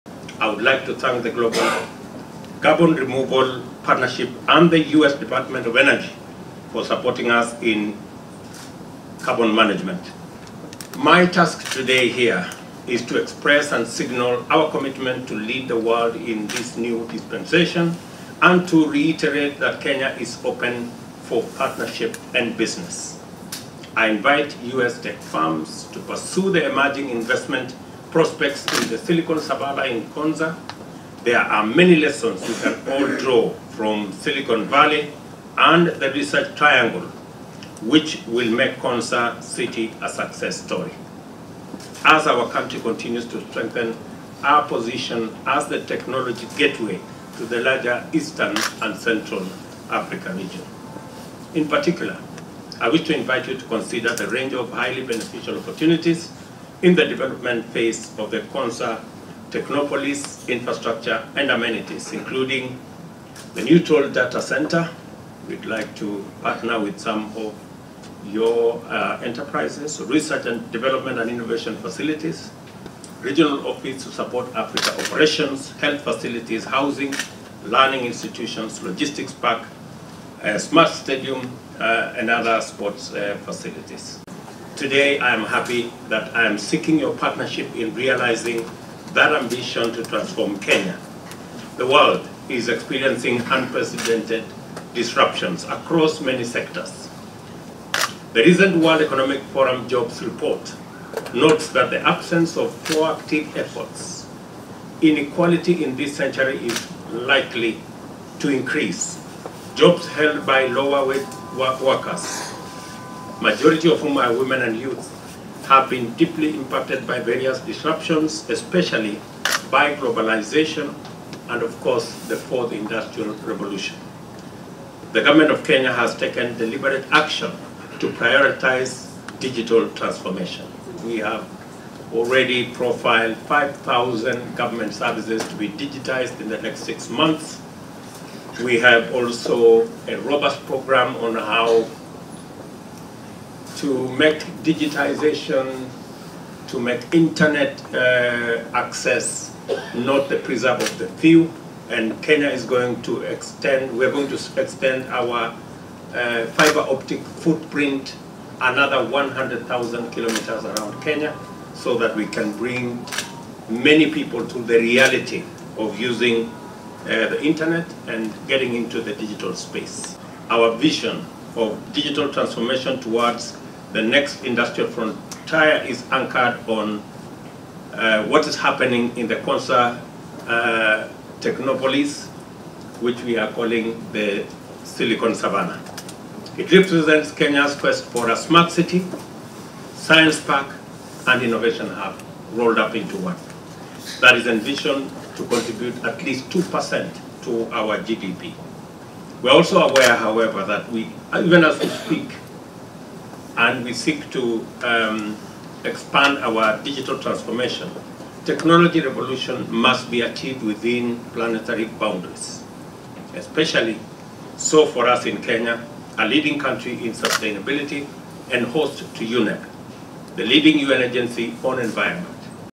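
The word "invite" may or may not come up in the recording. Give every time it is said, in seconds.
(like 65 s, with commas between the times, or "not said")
24 s, 53 s.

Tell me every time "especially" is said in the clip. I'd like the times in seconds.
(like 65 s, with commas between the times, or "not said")
118 s, 213 s.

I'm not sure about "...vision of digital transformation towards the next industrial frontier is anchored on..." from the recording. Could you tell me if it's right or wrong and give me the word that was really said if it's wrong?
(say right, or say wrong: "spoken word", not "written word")
right.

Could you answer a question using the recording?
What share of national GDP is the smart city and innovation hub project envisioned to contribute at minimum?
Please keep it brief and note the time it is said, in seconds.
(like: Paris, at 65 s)
2%, at 196 s.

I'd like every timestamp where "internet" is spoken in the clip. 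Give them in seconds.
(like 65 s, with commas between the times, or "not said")
147 s, 167 s.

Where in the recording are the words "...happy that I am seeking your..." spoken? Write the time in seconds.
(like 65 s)
85 s.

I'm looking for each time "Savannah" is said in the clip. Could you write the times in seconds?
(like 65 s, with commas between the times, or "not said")
29 s, 185 s.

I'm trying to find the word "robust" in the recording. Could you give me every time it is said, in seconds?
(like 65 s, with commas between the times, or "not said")
140 s.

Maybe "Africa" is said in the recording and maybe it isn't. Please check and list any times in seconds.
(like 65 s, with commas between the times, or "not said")
49 s, 74 s.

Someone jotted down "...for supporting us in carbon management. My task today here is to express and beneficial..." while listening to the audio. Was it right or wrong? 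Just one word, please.
wrong.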